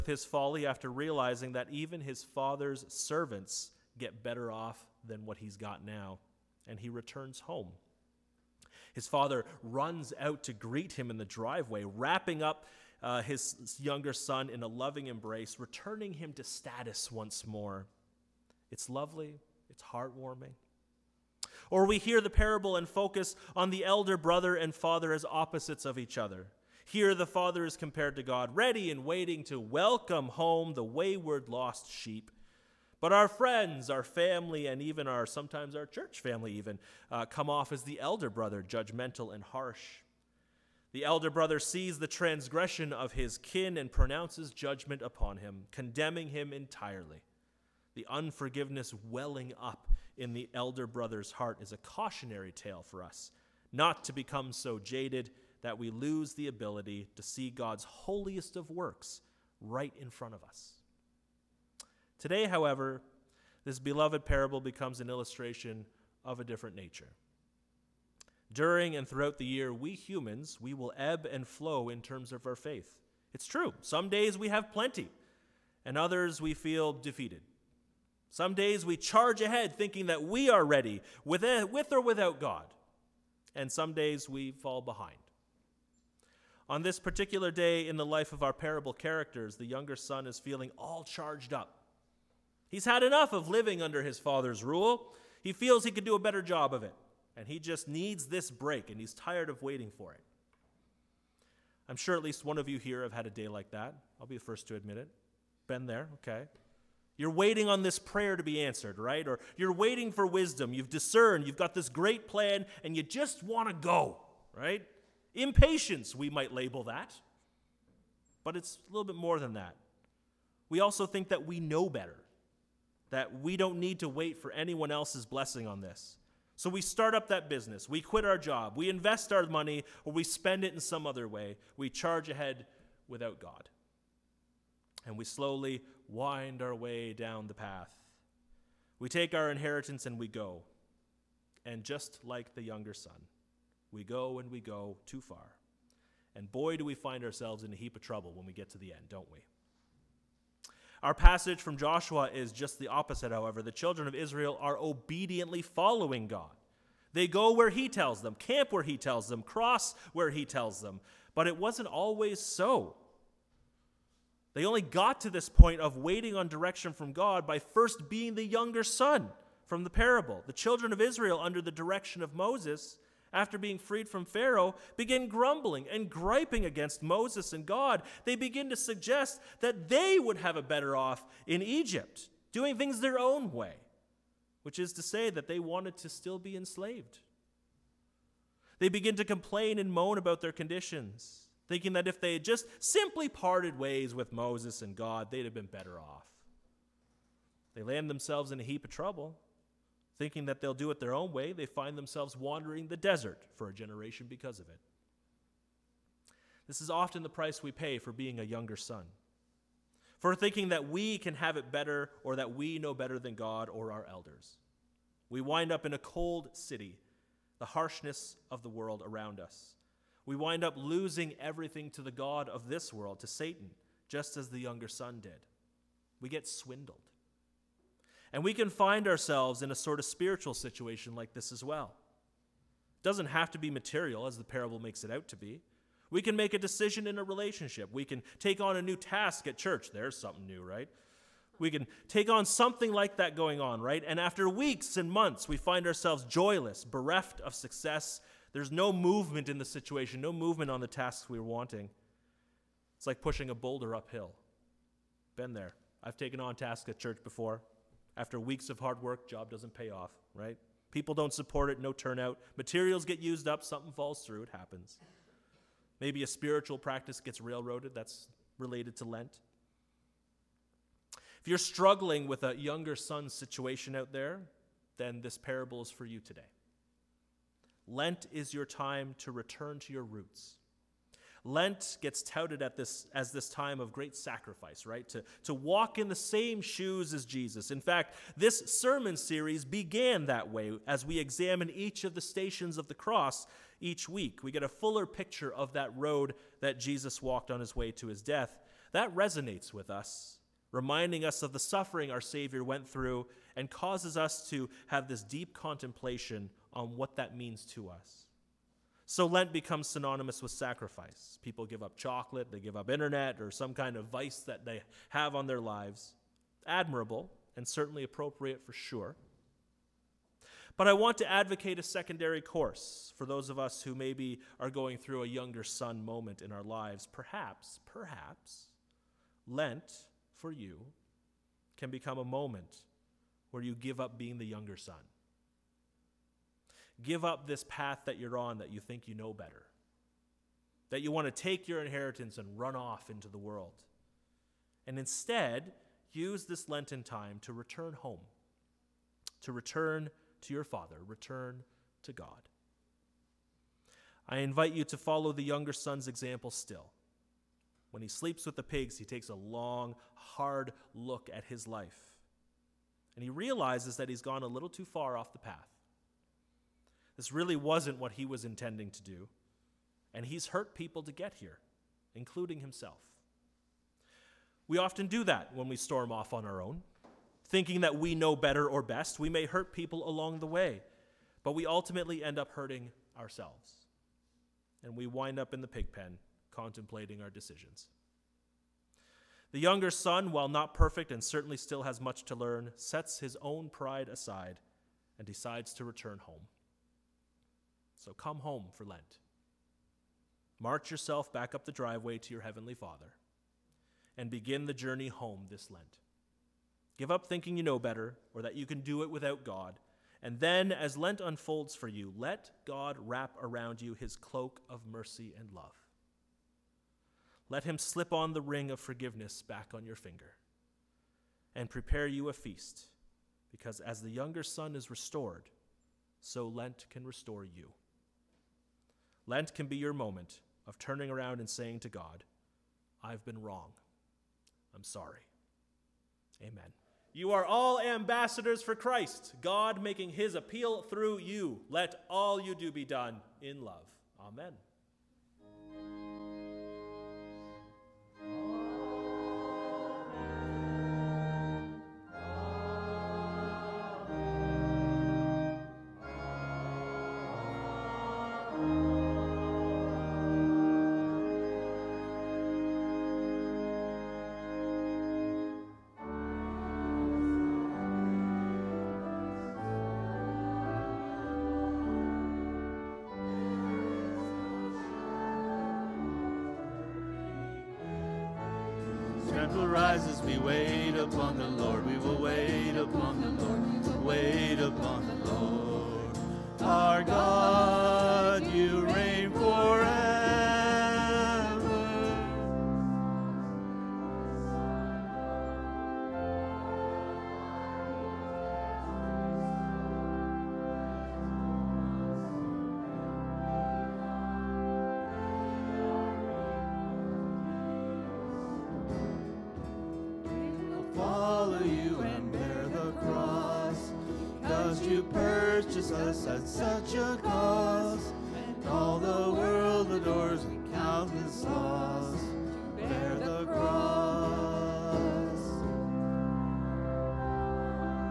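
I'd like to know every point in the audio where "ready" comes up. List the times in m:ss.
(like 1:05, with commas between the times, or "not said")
0:28, 1:20.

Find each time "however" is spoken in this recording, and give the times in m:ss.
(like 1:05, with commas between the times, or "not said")
1:02, 2:33.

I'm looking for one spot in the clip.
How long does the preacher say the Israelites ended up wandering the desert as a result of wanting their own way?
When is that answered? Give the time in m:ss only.
3:23.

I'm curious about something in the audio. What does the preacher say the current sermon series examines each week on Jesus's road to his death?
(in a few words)
stations of the cross.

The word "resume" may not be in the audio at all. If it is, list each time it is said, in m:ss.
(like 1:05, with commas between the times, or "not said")
not said.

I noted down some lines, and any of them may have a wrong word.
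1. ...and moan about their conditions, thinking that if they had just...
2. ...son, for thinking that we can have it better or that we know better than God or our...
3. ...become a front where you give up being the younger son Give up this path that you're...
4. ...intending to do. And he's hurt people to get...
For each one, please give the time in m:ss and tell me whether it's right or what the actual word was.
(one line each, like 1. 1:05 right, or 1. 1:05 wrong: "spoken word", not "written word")
1. 3:09 right
2. 3:28 right
3. 5:31 wrong: "moment", not "front"
4. 6:08 right.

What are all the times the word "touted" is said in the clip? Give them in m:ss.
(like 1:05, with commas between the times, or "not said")
4:42.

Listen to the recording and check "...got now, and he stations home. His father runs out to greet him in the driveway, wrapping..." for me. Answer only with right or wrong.
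wrong.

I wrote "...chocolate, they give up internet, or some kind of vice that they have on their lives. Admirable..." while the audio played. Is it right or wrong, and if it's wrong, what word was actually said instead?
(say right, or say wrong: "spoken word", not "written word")
right.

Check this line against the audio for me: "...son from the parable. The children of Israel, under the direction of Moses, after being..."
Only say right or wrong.
right.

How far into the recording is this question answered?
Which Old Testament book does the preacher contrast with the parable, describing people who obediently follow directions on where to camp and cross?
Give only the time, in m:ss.
2:31.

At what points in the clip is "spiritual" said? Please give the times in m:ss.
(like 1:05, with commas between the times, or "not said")
3:50, 4:26.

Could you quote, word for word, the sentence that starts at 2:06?
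So we start up that business, we quit our job, we invest our money, or we spend it in some other way.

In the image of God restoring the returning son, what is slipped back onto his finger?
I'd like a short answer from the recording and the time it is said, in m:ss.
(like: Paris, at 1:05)
the ring of forgiveness, at 6:58.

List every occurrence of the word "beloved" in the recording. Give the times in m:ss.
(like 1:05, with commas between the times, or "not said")
1:03.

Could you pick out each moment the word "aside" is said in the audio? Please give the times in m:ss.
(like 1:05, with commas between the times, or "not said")
6:34.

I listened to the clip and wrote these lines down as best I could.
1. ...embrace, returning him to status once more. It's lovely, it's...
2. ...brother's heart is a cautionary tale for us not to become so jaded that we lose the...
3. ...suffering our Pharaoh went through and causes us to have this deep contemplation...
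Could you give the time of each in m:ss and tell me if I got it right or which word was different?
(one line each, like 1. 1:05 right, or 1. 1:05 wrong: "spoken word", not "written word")
1. 0:15 right
2. 0:50 right
3. 5:01 wrong: "Savior", not "Pharaoh".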